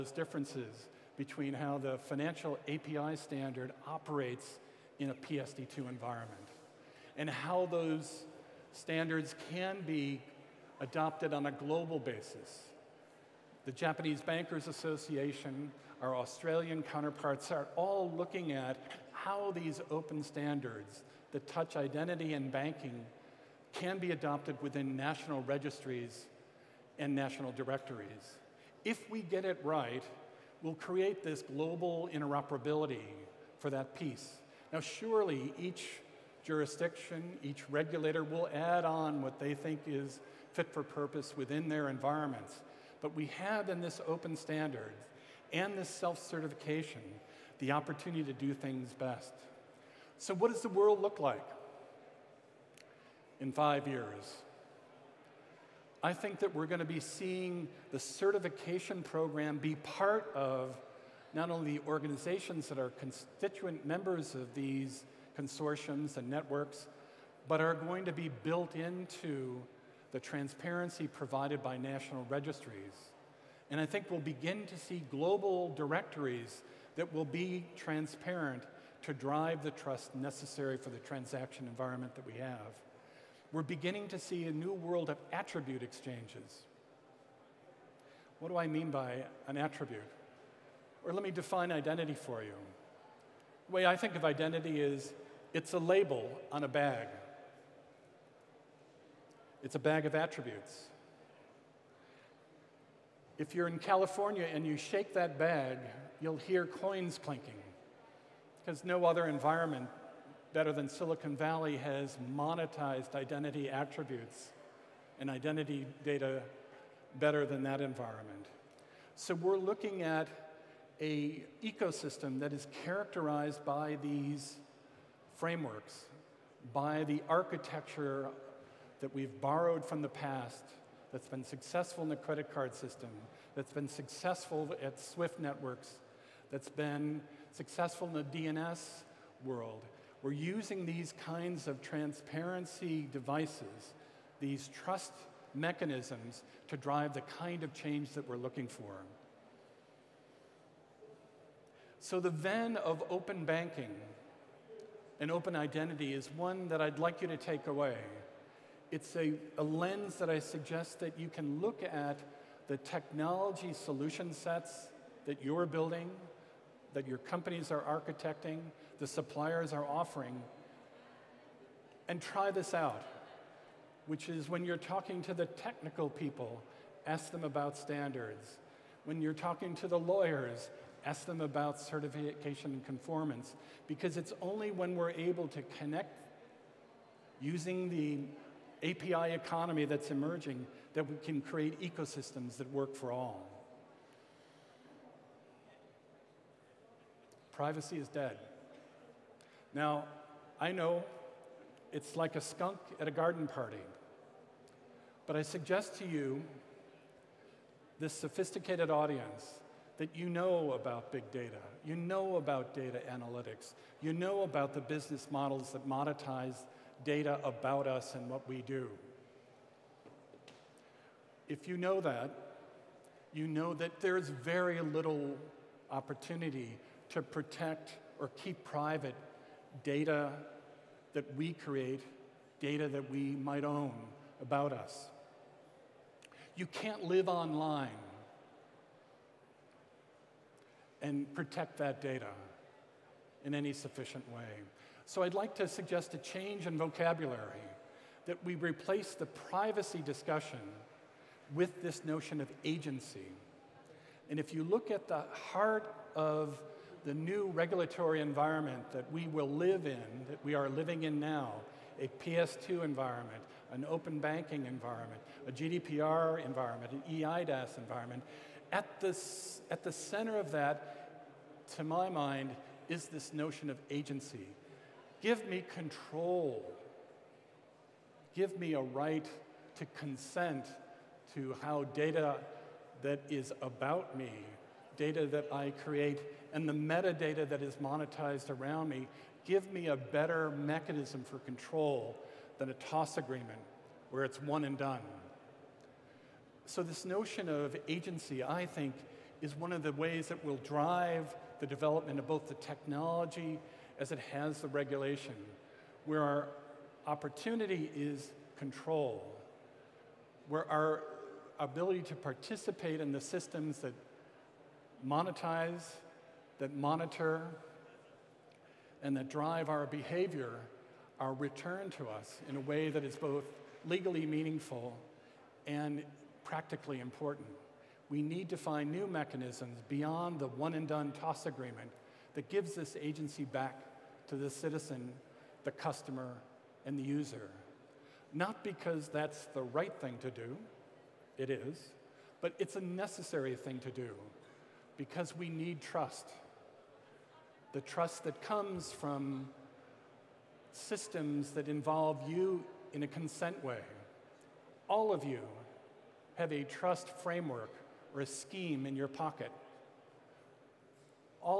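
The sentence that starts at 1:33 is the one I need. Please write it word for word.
The way I think of identity is it's a label on a bag, it's a bag of attributes.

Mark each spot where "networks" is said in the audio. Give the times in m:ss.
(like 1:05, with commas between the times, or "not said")
1:06, 2:15.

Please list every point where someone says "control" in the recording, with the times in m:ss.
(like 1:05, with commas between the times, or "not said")
4:35, 4:51, 5:08.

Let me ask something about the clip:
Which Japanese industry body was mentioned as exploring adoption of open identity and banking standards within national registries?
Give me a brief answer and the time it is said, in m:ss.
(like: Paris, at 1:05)
Japanese Bankers Association, at 0:13.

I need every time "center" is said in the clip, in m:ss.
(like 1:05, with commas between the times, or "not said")
4:29.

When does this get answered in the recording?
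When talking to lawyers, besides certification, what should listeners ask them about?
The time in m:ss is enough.
3:02.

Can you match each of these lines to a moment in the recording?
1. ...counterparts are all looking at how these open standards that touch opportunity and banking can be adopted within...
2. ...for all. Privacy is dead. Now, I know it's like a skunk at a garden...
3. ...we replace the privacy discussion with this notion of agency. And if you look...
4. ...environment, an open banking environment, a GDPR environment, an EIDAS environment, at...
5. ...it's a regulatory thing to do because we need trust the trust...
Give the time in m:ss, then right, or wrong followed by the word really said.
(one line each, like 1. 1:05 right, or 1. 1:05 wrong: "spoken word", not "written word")
1. 0:16 wrong: "identity", not "opportunity"
2. 3:12 right
3. 4:08 right
4. 4:22 right
5. 5:42 wrong: "necessary", not "regulatory".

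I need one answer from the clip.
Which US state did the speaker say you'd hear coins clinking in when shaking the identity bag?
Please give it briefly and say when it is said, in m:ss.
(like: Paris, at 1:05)
California, at 1:43.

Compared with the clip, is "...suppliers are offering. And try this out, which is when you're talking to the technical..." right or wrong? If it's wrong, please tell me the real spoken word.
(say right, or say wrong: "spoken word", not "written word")
right.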